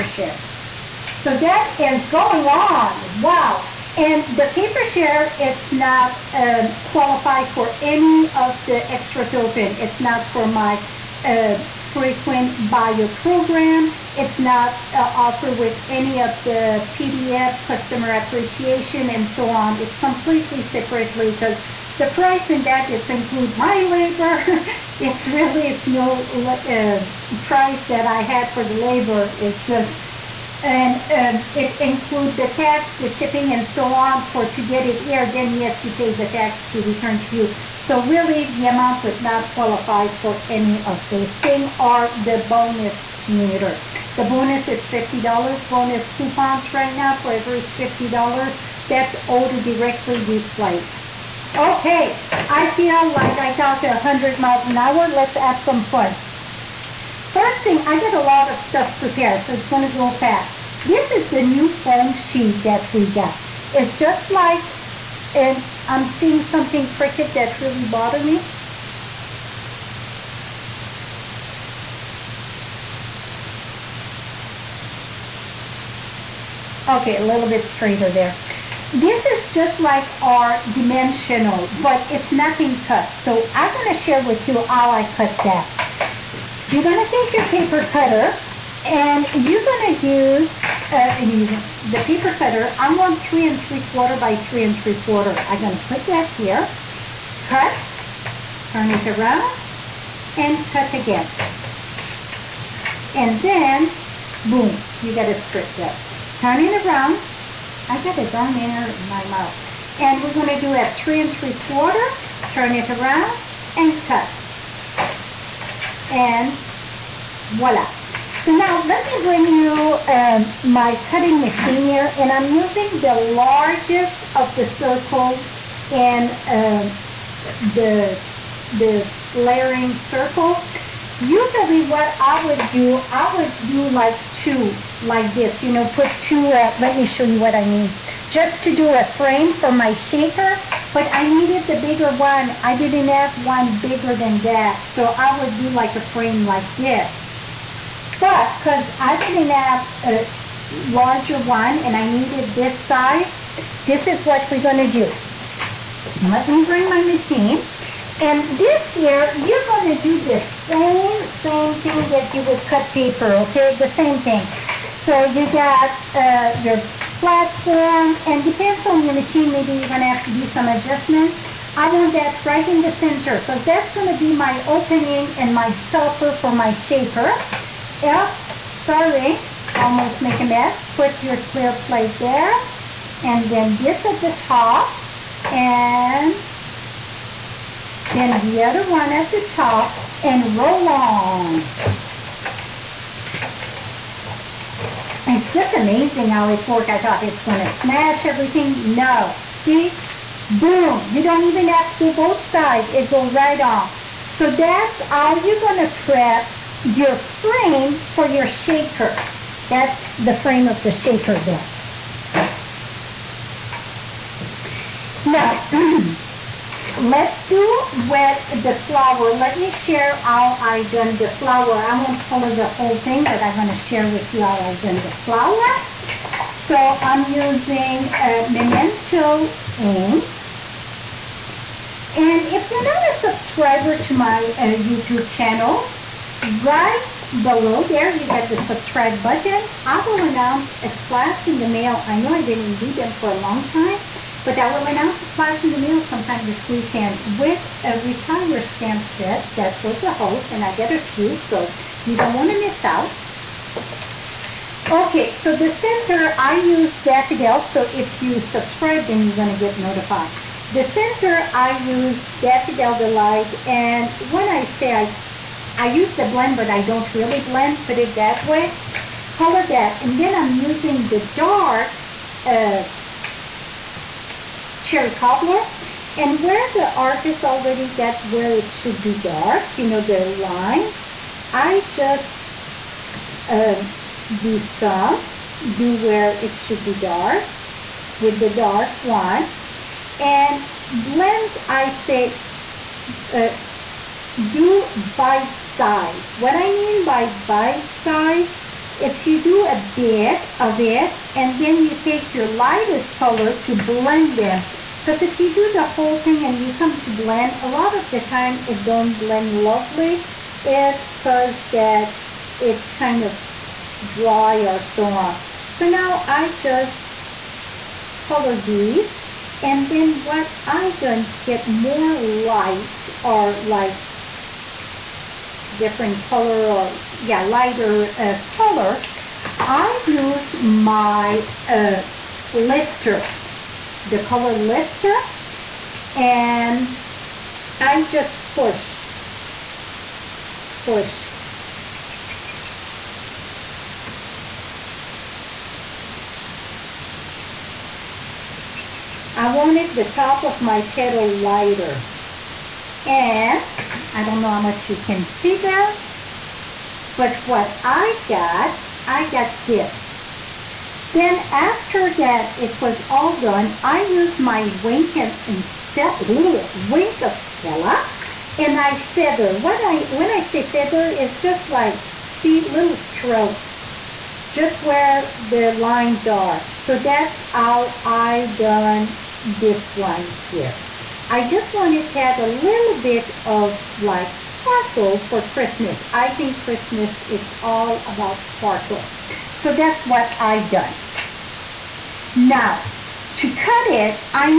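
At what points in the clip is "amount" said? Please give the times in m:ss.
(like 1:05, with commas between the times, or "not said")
0:38.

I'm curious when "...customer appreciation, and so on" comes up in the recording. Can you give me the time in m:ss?
0:17.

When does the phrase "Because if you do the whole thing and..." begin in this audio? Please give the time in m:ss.
5:05.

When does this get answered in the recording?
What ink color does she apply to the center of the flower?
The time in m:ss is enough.
4:22.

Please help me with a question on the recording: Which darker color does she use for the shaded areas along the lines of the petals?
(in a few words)
Cherry Cobbler.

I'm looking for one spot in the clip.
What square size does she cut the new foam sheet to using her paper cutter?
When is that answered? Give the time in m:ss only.
1:33.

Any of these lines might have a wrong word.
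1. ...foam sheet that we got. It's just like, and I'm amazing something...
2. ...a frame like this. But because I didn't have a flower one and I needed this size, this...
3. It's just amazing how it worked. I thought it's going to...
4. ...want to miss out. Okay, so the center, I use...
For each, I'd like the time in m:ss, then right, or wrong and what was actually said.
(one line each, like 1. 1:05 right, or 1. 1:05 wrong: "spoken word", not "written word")
1. 1:01 wrong: "seeing", not "amazing"
2. 2:25 wrong: "larger", not "flower"
3. 3:15 right
4. 4:12 right.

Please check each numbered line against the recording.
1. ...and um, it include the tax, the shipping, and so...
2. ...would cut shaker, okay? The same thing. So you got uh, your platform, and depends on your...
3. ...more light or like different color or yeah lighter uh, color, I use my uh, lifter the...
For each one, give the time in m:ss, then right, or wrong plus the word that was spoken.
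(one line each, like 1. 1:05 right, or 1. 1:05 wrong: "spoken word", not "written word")
1. 0:30 right
2. 2:42 wrong: "paper", not "shaker"
3. 5:21 right.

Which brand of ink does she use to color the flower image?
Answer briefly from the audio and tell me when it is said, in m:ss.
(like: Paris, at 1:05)
Memento, at 3:48.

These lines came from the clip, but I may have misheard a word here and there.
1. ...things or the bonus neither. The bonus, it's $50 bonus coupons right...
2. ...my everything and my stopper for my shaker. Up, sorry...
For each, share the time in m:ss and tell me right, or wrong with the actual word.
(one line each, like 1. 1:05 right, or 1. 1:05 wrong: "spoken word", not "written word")
1. 0:41 right
2. 2:54 wrong: "opening", not "everything".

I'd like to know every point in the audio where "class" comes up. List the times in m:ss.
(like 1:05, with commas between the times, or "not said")
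4:00, 4:05.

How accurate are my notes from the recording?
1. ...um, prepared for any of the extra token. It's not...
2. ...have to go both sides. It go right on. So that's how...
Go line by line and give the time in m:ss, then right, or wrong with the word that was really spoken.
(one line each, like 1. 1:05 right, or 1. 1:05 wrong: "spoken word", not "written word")
1. 0:06 wrong: "qualified", not "prepared"
2. 3:21 right.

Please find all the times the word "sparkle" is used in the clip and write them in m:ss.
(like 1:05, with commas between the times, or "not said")
6:24, 6:28.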